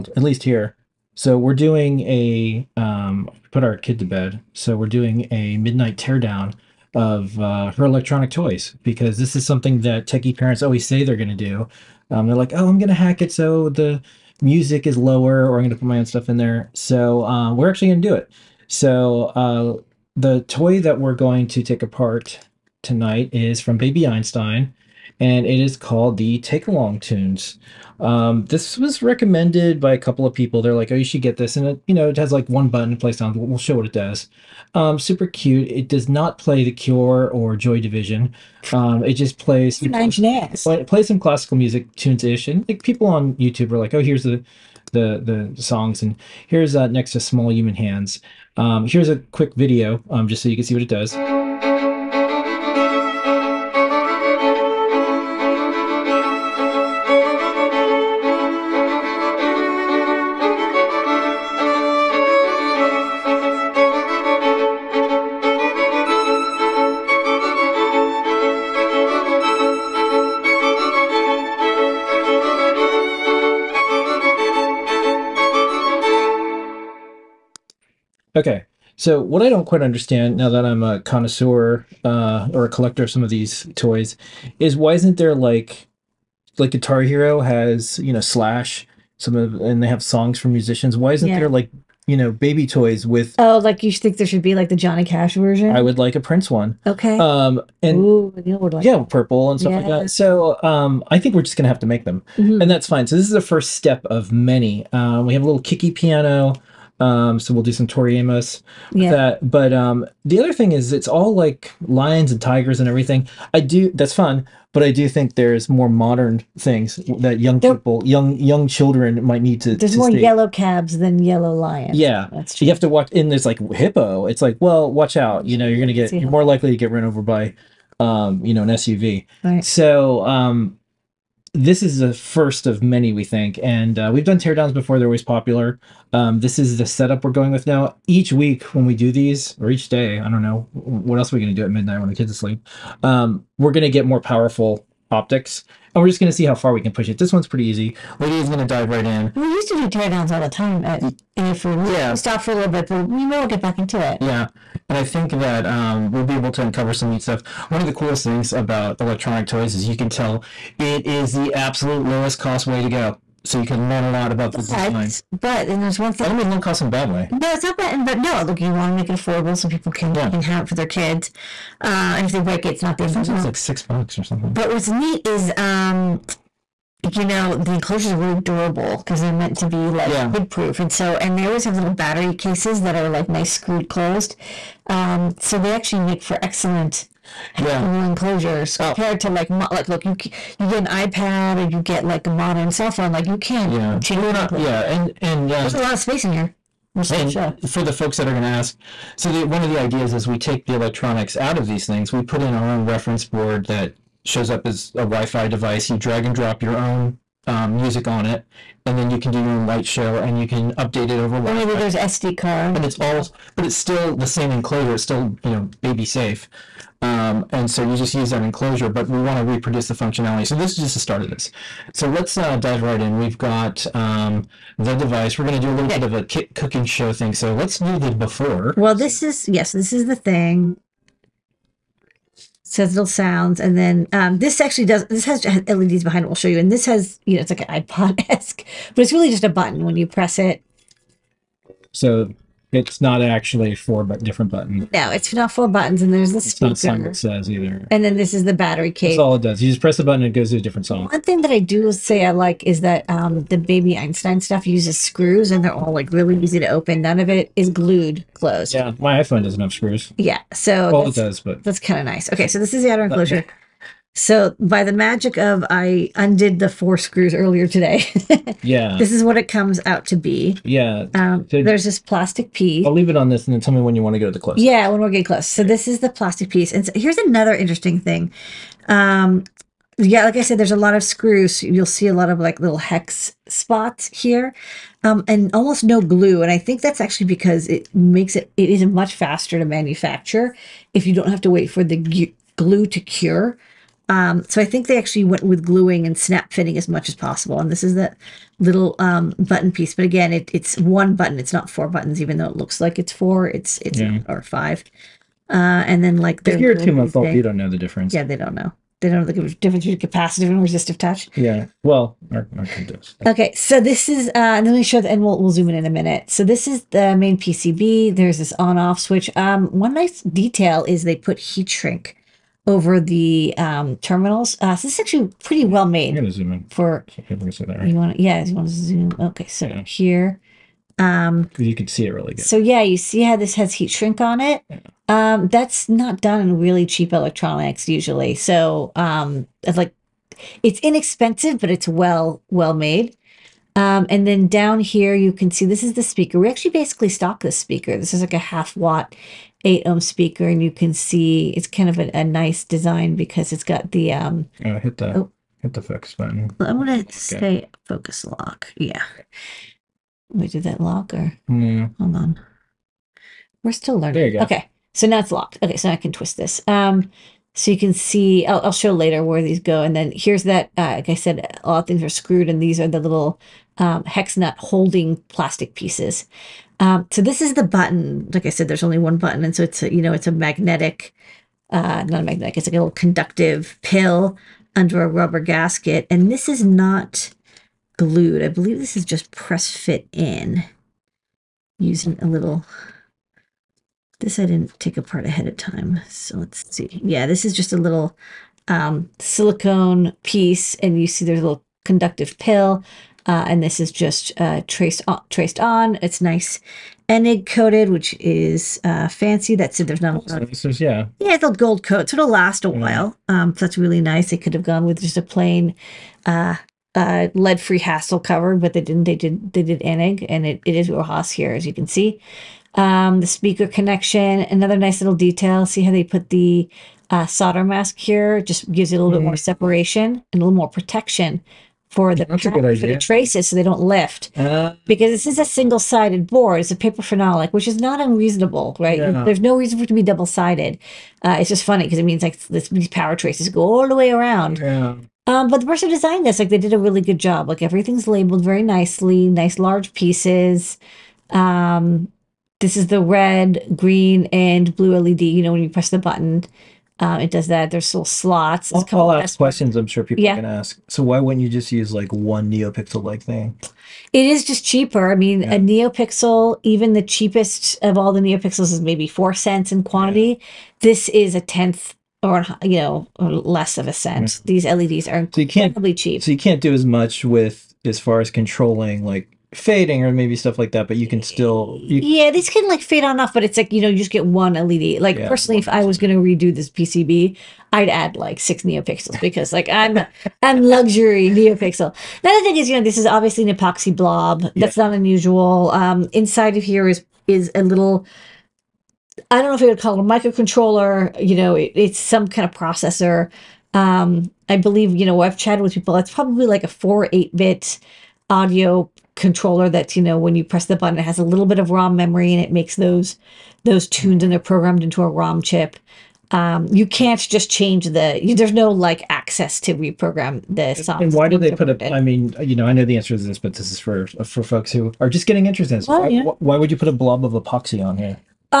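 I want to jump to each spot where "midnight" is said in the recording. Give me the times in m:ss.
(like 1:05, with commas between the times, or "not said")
0:05, 2:21.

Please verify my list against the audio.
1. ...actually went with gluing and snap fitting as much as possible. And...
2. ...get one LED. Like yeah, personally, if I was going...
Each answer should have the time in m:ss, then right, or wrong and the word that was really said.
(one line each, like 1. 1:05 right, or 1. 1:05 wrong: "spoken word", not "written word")
1. 4:54 right
2. 8:04 right.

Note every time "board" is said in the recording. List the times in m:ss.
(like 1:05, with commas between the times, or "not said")
3:23, 7:16.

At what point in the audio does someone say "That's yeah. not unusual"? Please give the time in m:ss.
8:14.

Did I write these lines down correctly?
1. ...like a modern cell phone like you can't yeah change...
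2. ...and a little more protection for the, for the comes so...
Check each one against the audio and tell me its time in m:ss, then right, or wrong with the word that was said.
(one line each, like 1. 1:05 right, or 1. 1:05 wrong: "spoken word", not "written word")
1. 3:12 right
2. 7:10 wrong: "traces", not "comes".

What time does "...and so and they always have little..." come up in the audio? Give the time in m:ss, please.
3:00.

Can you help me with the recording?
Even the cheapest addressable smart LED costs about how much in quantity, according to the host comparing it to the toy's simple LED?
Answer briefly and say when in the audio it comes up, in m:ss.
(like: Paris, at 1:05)
4 cents, at 7:49.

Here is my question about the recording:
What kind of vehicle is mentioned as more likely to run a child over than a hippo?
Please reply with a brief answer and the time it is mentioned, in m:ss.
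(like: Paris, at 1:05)
An SUV, at 2:08.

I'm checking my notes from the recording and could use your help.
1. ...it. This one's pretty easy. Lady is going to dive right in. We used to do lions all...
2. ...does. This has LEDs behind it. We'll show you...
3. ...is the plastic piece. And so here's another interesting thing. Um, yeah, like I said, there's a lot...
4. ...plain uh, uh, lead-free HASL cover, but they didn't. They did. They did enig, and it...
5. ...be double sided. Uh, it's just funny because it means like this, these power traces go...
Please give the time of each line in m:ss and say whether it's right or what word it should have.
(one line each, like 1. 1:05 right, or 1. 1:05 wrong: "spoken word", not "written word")
1. 2:27 wrong: "teardowns", not "lions"
2. 3:54 right
3. 4:35 right
4. 6:55 right
5. 7:19 right.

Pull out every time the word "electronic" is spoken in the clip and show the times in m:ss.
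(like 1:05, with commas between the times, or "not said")
0:07, 2:38, 3:20, 5:37.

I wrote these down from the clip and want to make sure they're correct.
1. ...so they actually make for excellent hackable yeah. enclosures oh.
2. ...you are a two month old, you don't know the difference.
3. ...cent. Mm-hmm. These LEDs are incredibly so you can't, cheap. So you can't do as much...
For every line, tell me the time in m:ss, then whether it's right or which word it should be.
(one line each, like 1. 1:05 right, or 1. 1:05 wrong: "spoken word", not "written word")
1. 3:05 right
2. 5:06 right
3. 7:53 right.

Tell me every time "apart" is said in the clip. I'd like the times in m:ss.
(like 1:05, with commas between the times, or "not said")
0:21, 6:34.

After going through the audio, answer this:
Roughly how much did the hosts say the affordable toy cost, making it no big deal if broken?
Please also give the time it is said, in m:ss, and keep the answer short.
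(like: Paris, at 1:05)
6 bucks, at 2:53.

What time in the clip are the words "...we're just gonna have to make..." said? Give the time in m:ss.
1:41.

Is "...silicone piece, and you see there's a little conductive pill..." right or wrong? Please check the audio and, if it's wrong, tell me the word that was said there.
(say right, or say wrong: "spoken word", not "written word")
right.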